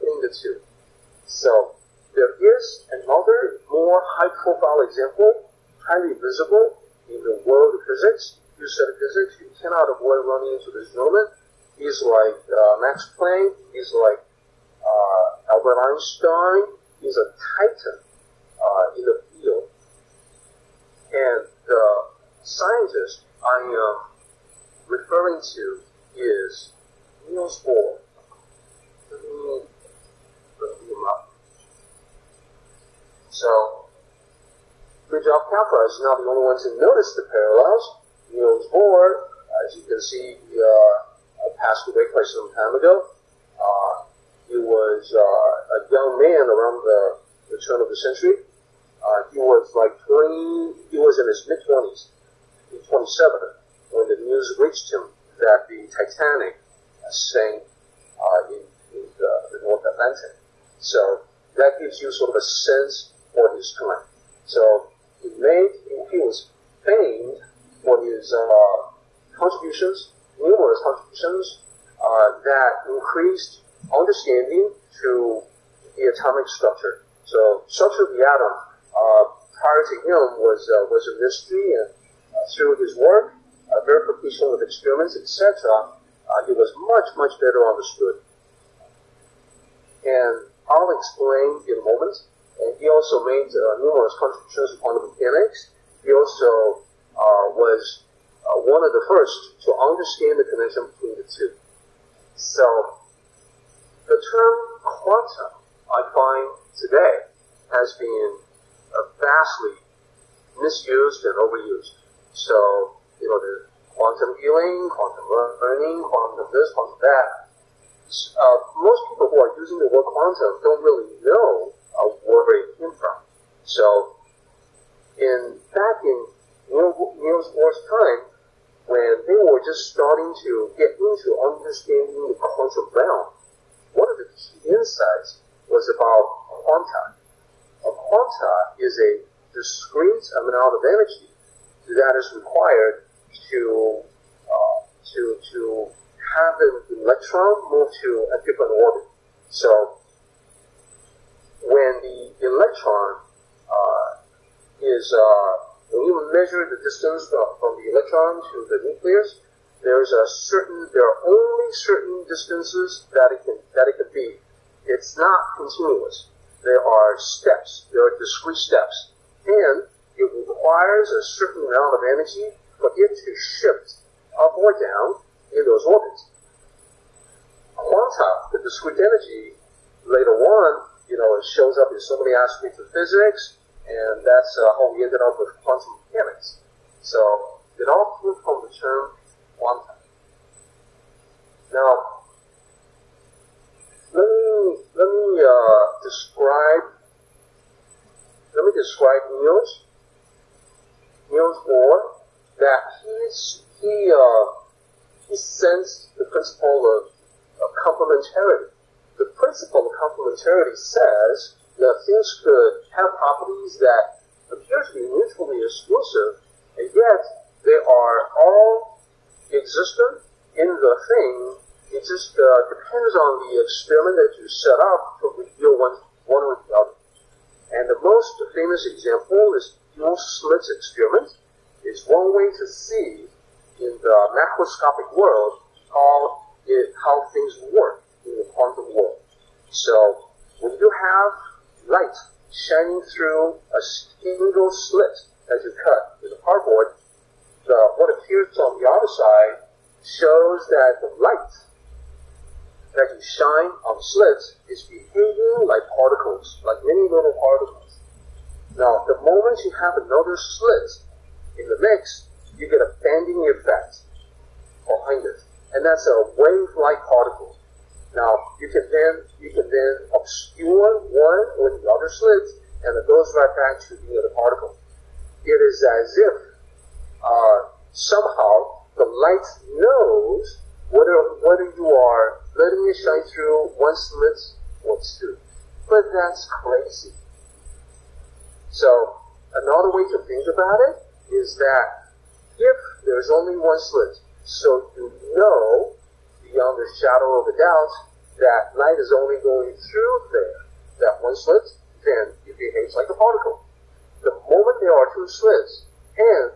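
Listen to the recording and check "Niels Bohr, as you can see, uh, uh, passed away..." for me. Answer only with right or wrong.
right.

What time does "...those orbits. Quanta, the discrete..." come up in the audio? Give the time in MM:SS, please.
02:55.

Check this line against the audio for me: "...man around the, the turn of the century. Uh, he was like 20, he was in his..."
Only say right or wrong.
right.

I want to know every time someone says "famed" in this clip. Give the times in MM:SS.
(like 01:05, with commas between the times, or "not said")
01:06.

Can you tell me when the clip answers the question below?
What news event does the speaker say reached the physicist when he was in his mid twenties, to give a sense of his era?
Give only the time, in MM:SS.
00:55.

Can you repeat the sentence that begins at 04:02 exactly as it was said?
shining through a single slit as you cut with a cardboard.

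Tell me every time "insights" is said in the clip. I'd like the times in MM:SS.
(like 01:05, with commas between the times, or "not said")
02:14.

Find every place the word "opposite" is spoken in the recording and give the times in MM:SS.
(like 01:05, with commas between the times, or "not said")
not said.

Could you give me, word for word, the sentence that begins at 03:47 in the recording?
And the most famous example is Yule slit experiment.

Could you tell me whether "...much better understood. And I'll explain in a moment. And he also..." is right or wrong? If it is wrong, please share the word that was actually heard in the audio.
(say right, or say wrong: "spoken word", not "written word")
right.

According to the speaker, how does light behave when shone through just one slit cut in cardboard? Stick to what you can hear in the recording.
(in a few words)
Like particles.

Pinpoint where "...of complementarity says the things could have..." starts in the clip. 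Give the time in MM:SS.
03:29.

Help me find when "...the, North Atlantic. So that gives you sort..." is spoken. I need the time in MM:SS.
00:59.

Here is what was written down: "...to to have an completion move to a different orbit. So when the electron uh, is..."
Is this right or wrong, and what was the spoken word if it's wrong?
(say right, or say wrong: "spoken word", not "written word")
wrong: "electron", not "completion".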